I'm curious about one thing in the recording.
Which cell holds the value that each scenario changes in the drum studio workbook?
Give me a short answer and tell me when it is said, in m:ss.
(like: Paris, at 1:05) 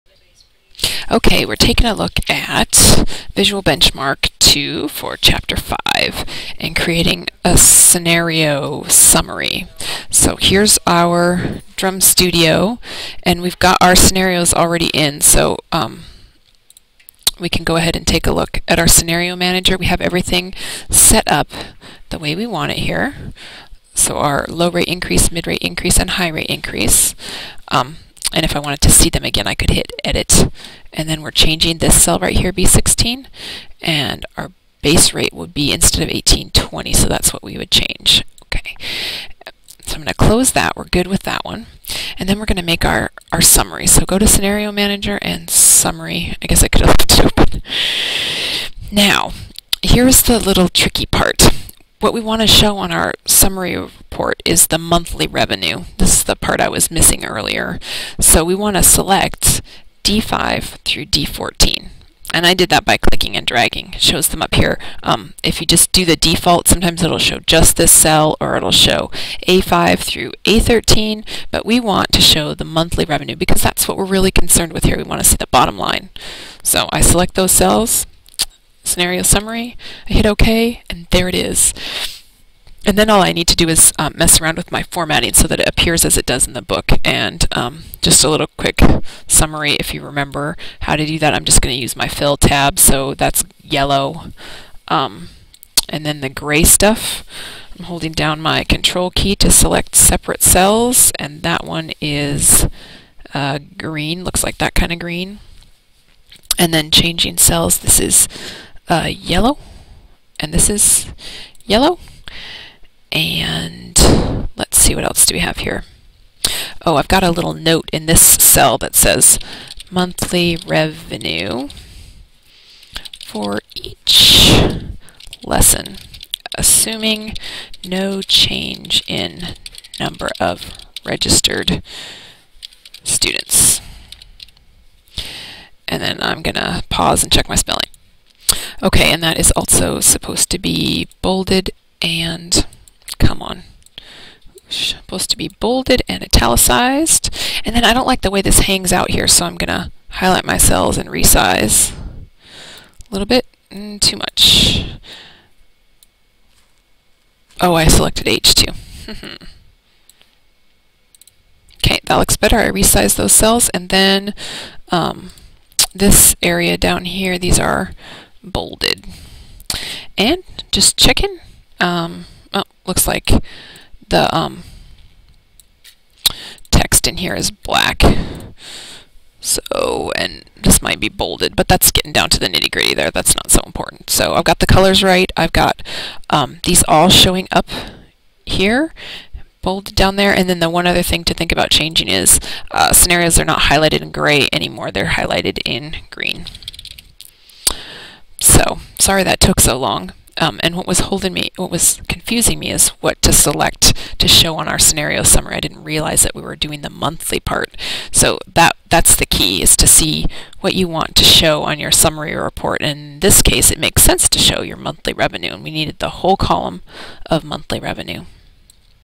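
B16, at 0:32.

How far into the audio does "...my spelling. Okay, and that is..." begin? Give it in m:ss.
2:17.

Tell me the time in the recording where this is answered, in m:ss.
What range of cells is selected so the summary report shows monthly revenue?
1:00.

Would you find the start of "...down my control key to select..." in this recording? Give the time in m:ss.
1:38.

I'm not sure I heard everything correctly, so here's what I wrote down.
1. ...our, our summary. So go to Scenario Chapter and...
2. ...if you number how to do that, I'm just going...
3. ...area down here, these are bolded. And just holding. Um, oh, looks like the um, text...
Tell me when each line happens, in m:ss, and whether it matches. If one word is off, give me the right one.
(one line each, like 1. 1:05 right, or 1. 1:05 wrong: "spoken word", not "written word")
1. 0:42 wrong: "Manager", not "Chapter"
2. 1:29 wrong: "remember", not "number"
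3. 2:46 wrong: "checking", not "holding".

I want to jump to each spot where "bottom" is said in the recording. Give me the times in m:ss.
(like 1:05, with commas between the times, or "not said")
1:15.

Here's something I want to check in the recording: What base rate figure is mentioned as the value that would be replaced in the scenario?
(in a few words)
1820.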